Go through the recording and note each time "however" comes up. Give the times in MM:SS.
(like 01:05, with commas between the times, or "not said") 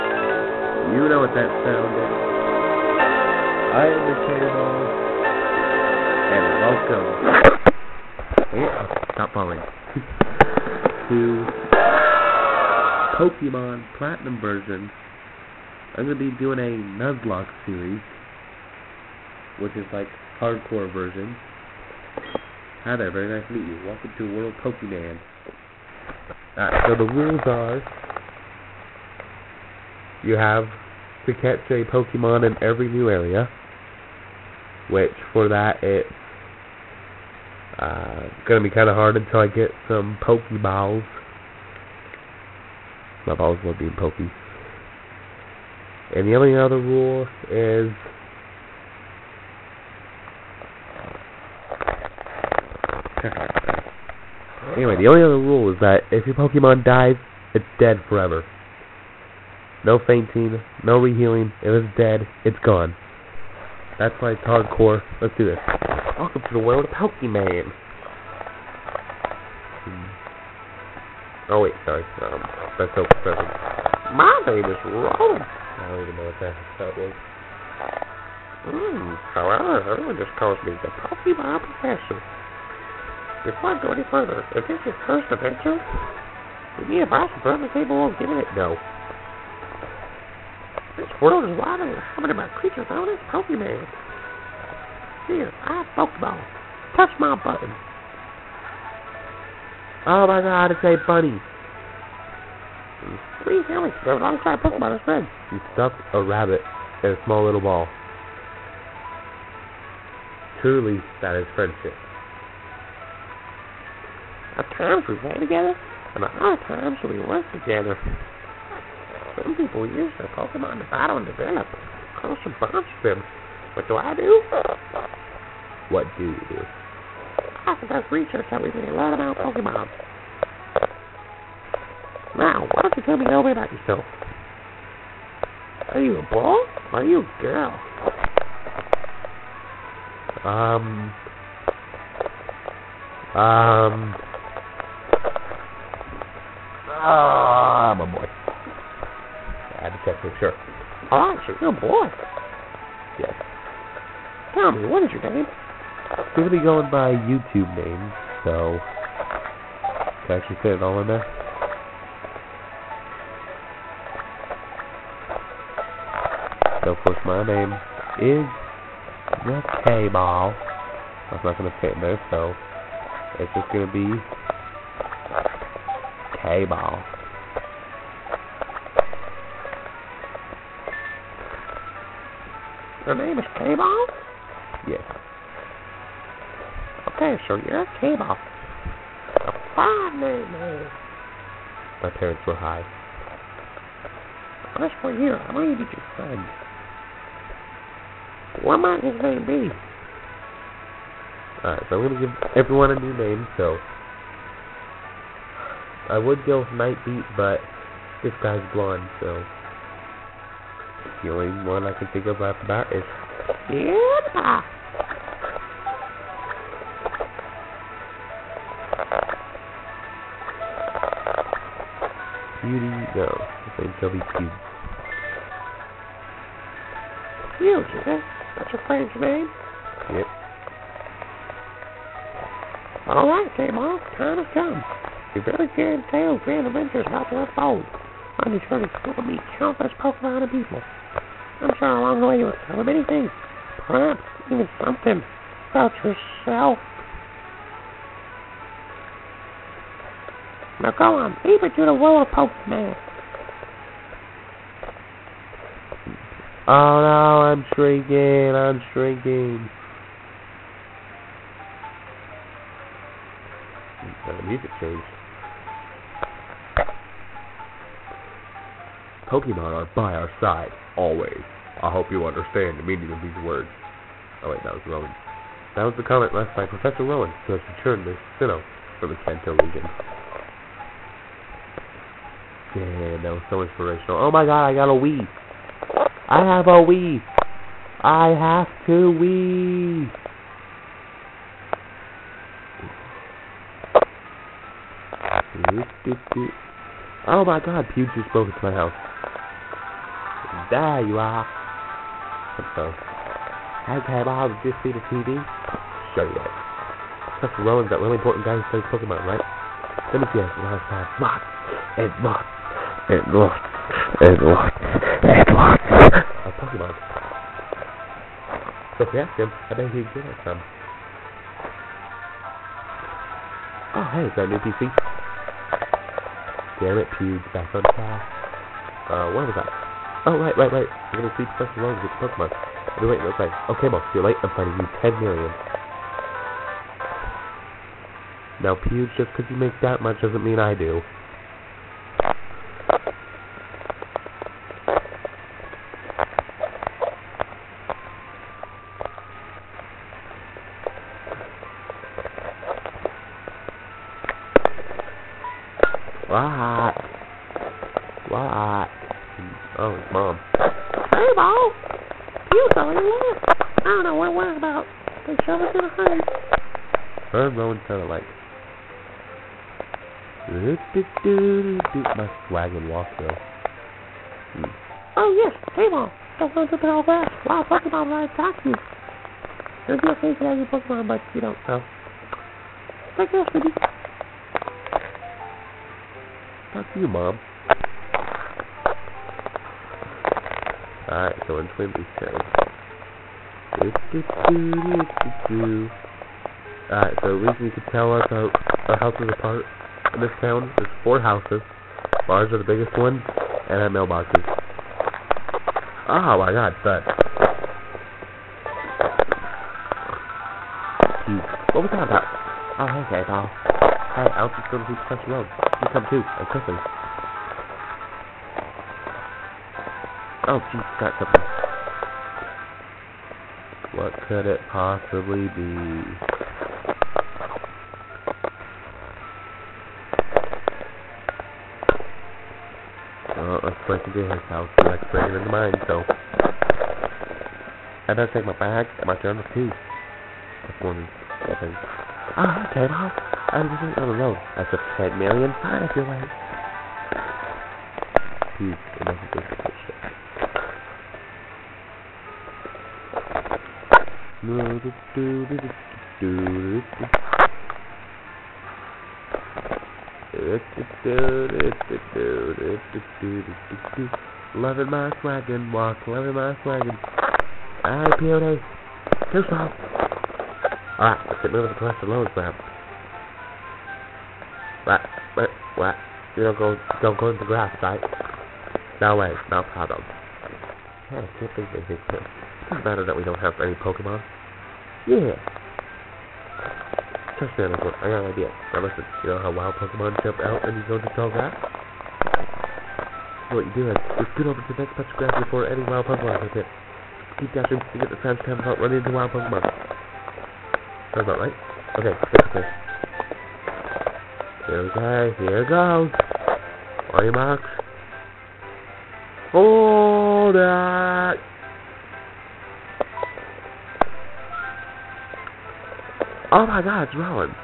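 01:19.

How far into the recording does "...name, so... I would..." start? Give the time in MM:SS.
03:23.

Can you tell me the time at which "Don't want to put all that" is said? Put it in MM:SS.
06:16.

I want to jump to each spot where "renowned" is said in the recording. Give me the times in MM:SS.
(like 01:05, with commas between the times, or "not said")
not said.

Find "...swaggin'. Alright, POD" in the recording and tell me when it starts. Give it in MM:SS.
07:46.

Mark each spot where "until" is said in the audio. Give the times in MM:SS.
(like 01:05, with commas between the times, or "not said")
00:39.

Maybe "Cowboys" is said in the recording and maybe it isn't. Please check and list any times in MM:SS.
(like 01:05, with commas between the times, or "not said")
not said.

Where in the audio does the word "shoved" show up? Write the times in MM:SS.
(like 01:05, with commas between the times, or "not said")
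06:05.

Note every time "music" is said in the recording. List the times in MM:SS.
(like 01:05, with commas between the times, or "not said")
04:24.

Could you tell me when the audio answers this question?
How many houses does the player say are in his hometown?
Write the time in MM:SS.
06:41.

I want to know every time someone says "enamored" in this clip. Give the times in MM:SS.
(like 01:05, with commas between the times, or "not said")
not said.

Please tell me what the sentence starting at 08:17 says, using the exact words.
Keep dashing to get the fast to out running into wild Pokemon.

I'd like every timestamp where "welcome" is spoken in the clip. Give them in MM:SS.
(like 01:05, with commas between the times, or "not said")
00:08, 00:23, 01:06.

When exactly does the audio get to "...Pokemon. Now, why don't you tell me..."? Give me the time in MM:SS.
02:09.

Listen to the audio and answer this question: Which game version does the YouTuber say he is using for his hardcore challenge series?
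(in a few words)
Pokemon Platinum.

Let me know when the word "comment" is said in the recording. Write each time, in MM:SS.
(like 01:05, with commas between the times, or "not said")
04:36.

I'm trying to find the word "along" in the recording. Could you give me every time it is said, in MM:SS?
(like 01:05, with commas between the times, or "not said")
04:01.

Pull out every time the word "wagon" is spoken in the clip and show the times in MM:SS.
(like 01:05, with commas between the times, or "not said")
06:12.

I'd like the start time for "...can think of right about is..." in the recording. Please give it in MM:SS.
03:31.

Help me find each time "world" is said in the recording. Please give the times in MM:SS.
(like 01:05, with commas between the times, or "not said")
00:24, 01:06, 01:31, 04:11.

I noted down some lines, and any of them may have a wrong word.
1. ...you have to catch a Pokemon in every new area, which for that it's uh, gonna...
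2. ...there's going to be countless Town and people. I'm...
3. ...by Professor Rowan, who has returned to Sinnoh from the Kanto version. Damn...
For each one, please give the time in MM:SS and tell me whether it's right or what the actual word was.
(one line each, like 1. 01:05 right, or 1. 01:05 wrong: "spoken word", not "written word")
1. 00:30 right
2. 03:58 wrong: "Pokemon", not "Town"
3. 04:36 wrong: "region", not "version".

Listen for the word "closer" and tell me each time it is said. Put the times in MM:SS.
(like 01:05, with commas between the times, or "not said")
02:02.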